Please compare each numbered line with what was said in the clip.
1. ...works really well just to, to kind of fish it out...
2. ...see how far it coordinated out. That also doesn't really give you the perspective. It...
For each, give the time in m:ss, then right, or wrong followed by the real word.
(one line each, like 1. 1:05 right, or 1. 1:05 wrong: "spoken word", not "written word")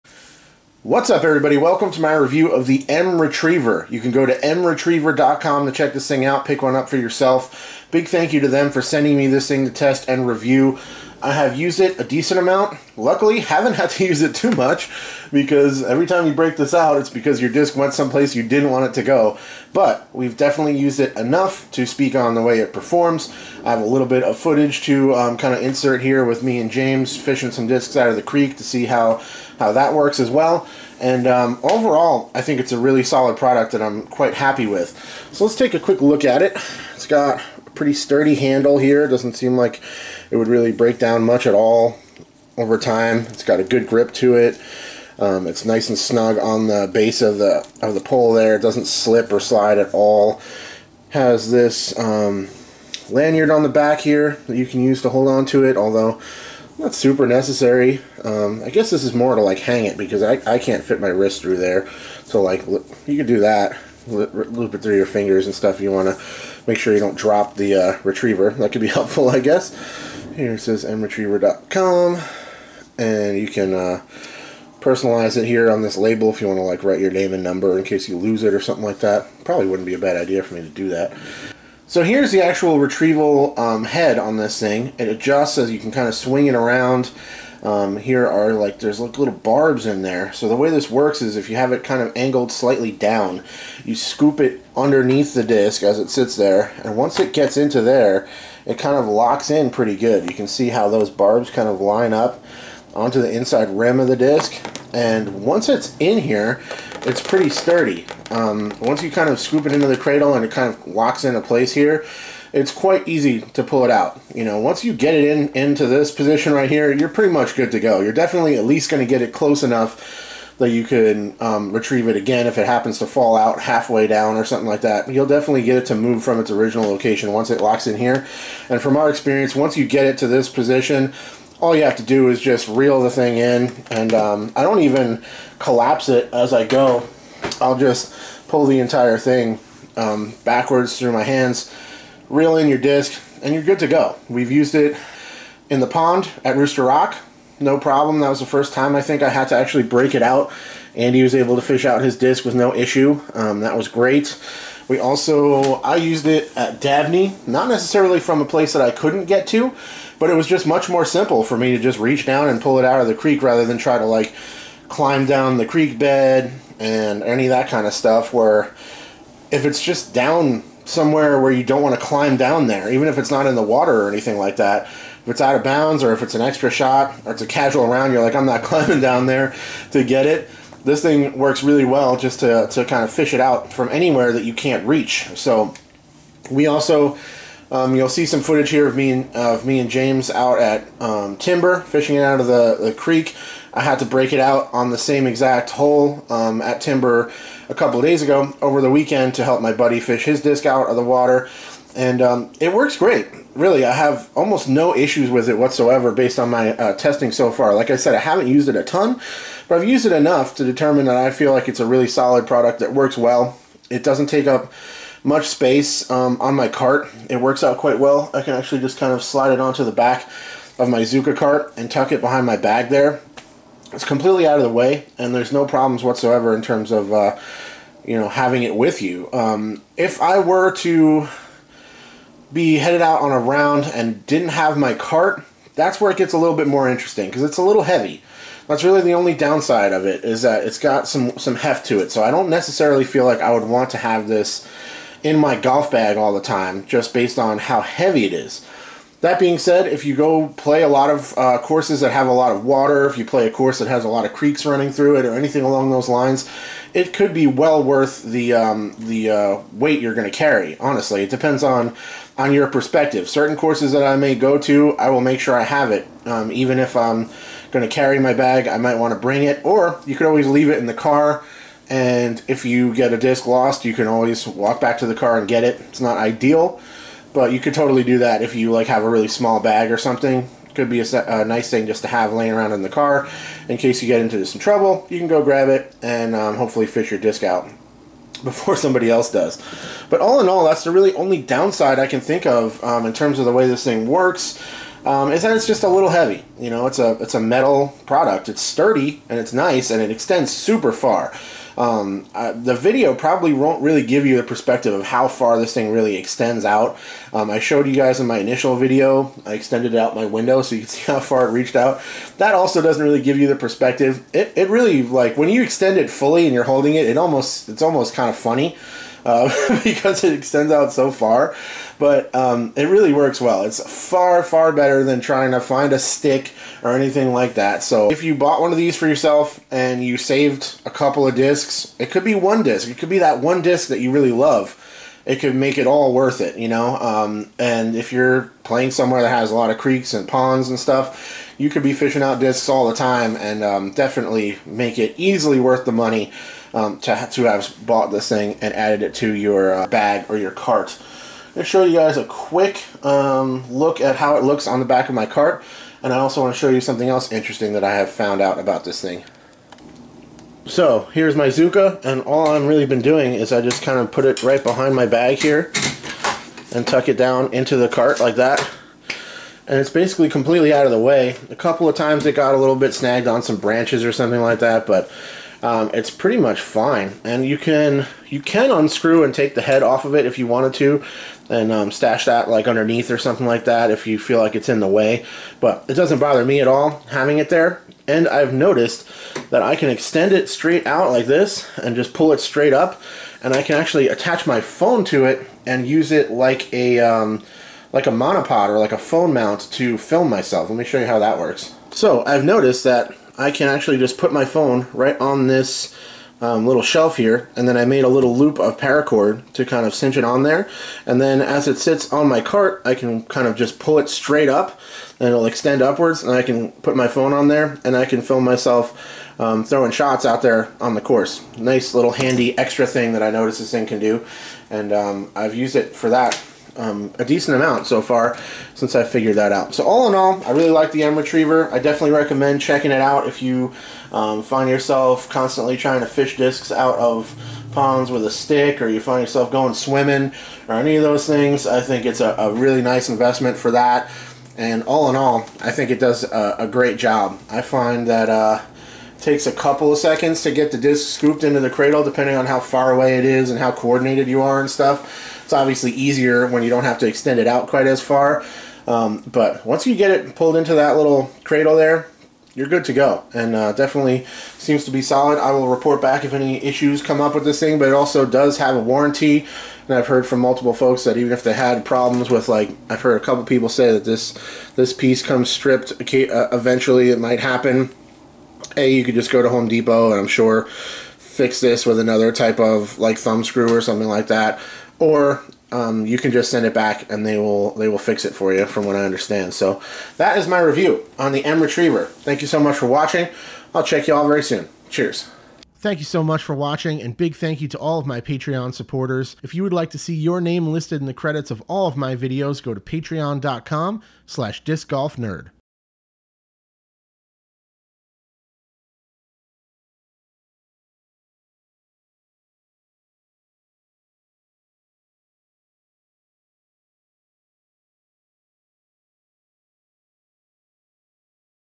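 1. 3:01 right
2. 5:10 wrong: "reached", not "coordinated".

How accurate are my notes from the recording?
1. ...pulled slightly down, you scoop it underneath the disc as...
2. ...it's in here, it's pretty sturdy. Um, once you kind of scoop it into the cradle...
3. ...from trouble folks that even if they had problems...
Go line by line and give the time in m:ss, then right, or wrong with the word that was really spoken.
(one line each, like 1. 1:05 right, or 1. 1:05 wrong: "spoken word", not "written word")
1. 1:32 wrong: "angled", not "pulled"
2. 1:45 right
3. 7:50 wrong: "multiple", not "trouble".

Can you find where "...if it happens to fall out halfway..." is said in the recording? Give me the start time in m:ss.
2:02.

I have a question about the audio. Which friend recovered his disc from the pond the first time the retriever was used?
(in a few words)
Andy.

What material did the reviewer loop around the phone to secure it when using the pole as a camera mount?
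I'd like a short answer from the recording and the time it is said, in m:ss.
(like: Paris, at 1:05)
paracord, at 6:48.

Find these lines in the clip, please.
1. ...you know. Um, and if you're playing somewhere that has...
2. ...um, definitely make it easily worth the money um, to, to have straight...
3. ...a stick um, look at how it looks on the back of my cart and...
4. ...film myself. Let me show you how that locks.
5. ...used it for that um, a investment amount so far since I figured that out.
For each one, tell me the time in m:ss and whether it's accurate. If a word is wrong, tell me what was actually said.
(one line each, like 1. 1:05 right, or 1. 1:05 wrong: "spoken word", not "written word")
1. 5:36 right
2. 5:43 wrong: "bought", not "straight"
3. 5:52 wrong: "quick", not "stick"
4. 6:39 wrong: "works", not "locks"
5. 7:05 wrong: "decent", not "investment".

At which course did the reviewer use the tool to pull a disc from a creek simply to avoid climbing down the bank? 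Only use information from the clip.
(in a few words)
Dabney.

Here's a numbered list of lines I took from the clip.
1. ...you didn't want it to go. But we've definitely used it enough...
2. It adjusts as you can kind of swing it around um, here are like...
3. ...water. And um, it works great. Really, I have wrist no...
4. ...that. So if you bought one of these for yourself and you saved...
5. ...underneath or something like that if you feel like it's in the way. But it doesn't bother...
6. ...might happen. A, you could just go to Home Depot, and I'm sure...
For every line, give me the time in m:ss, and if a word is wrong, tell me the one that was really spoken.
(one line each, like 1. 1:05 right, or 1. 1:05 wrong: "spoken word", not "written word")
1. 0:18 right
2. 1:24 right
3. 3:21 wrong: "almost", not "wrist"
4. 5:27 right
5. 6:22 right
6. 7:57 right.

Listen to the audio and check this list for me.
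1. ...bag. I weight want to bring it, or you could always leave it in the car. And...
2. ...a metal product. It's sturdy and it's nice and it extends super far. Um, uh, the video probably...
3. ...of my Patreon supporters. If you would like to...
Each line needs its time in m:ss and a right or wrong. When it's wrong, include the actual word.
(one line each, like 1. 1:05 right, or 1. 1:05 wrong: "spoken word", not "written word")
1. 4:28 wrong: "might", not "weight"
2. 4:57 right
3. 8:17 right.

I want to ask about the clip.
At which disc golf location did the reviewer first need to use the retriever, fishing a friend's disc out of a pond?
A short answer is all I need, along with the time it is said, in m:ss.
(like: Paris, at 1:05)
Rooster Rock, at 2:26.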